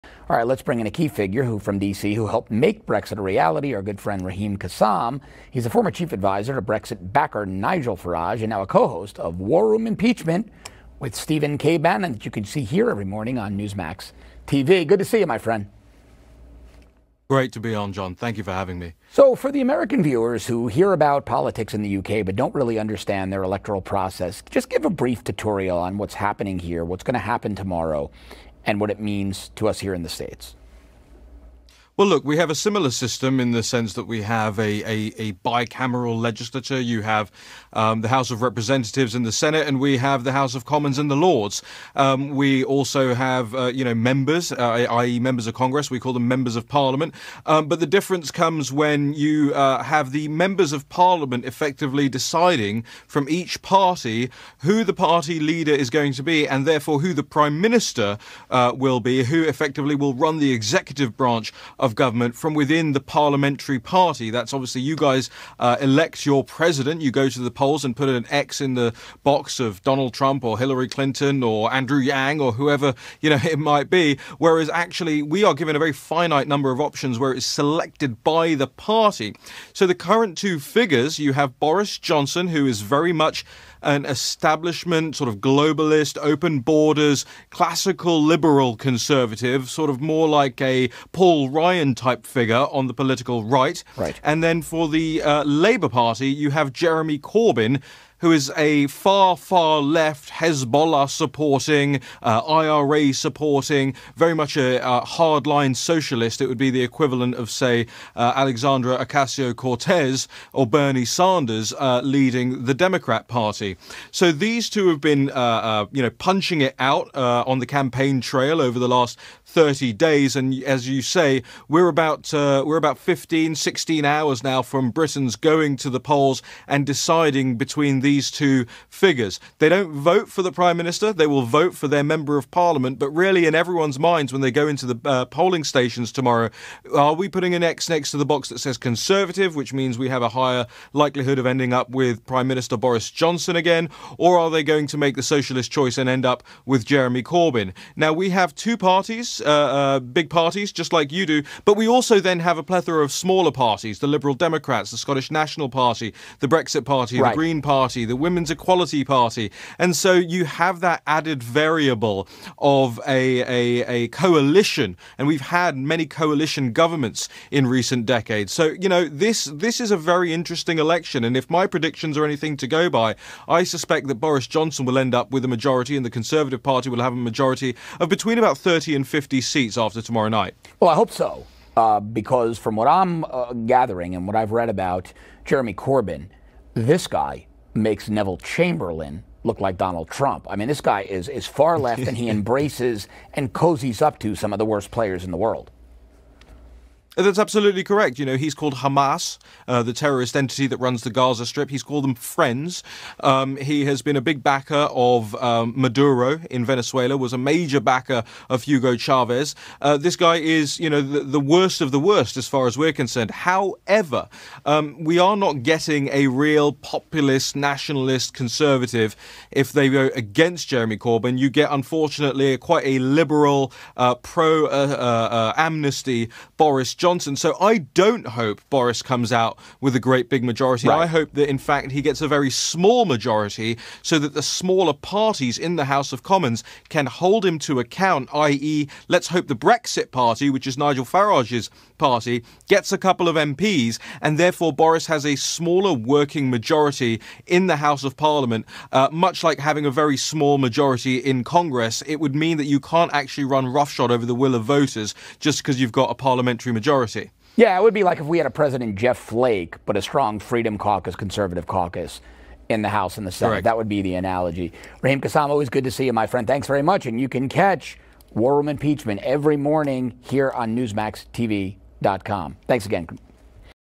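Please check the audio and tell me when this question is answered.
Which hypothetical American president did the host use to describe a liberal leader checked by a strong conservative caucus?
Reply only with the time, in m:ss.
4:18.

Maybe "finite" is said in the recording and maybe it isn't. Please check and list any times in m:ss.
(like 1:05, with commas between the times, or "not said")
1:15.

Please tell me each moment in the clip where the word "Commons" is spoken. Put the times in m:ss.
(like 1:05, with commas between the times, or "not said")
0:40, 3:56.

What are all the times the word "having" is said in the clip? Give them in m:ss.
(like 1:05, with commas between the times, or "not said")
0:18, 4:09.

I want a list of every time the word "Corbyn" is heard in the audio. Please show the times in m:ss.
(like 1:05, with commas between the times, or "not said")
1:37, 2:27, 3:05, 3:40.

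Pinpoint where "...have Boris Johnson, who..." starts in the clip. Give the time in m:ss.
1:21.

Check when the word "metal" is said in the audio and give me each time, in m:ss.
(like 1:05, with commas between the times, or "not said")
not said.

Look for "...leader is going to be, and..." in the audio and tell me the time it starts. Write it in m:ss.
0:55.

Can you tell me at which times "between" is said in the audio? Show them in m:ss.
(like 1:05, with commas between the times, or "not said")
2:07, 2:58.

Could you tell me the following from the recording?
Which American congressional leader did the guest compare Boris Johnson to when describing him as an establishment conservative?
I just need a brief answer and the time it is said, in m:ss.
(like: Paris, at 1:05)
Paul Ryan, at 1:31.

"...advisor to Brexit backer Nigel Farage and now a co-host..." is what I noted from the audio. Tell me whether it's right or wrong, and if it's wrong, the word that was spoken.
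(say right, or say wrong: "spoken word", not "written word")
right.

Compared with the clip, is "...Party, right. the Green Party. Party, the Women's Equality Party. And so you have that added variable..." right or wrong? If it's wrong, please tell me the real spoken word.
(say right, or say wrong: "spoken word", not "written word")
right.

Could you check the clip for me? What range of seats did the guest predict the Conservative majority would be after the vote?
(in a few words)
30 to 50.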